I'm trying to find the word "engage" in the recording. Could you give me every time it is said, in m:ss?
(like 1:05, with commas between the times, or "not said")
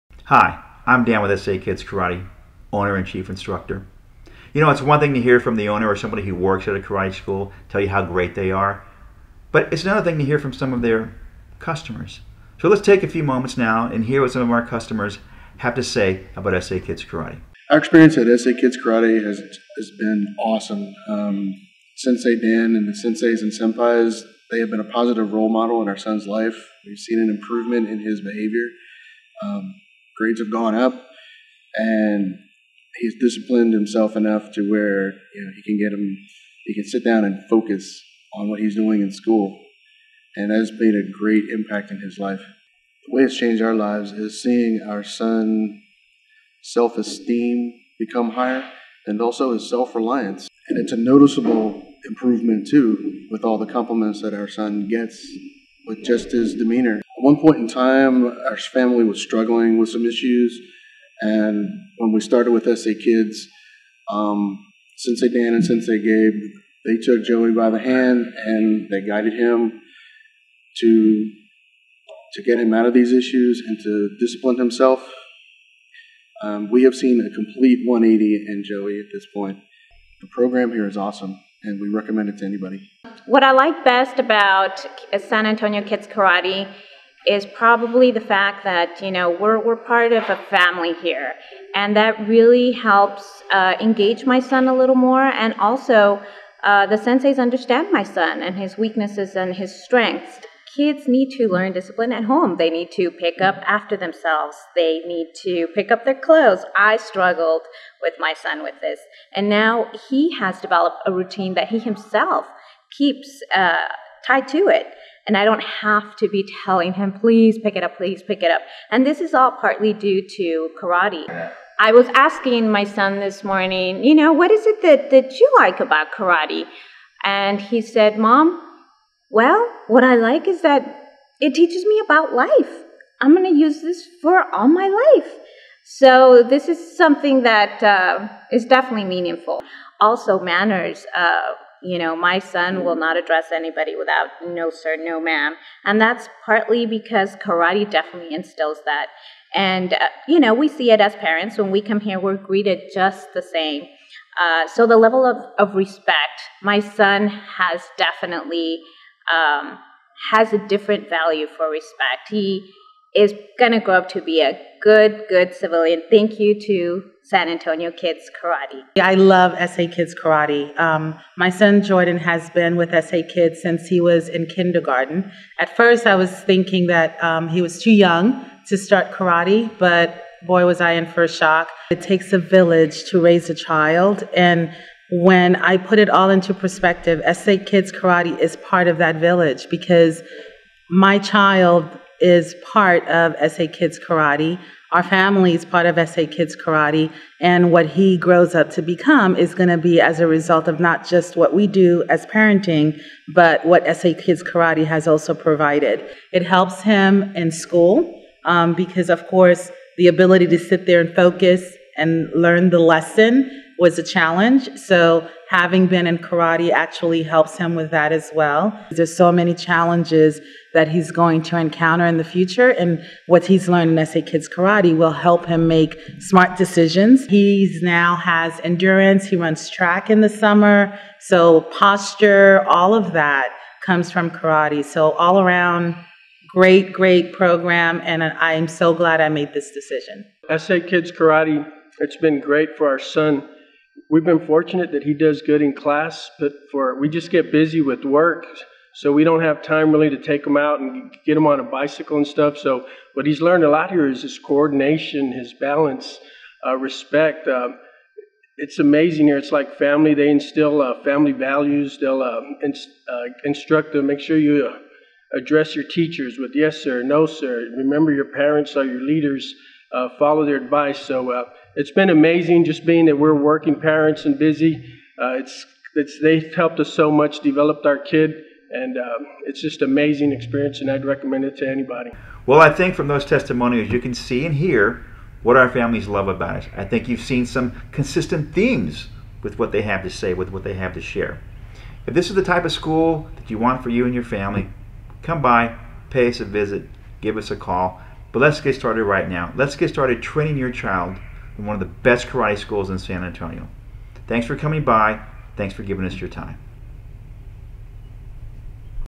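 1:33.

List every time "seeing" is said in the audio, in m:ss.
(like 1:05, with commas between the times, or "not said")
0:44.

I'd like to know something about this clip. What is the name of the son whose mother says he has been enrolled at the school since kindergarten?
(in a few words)
Jordan.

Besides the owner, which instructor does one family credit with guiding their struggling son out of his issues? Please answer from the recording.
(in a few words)
Sensei Gabe.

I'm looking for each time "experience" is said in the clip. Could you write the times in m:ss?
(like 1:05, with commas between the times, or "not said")
0:17, 4:40.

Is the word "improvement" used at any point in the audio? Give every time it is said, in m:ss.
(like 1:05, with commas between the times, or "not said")
0:27, 0:52.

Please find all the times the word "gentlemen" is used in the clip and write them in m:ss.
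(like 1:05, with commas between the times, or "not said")
not said.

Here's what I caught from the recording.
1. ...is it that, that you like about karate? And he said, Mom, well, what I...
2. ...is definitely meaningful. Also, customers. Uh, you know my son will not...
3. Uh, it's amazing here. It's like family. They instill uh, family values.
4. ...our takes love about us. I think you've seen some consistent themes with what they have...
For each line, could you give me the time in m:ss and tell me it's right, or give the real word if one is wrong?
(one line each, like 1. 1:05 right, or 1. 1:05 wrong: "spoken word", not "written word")
1. 2:04 right
2. 2:18 wrong: "manners", not "customers"
3. 4:17 right
4. 4:45 wrong: "families", not "takes".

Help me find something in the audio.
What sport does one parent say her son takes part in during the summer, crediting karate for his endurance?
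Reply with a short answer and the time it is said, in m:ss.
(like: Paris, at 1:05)
track, at 3:49.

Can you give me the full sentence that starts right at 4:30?
So uh, it's been amazing just being that we're working parents and busy.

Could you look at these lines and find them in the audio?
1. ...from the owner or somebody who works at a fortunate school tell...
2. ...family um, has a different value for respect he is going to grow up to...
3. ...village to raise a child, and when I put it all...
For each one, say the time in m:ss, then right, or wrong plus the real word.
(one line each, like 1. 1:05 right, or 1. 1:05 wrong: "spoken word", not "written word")
1. 0:05 wrong: "karate", not "fortunate"
2. 2:37 wrong: "definitely", not "family"
3. 3:02 right.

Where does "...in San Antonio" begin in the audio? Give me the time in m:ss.
5:02.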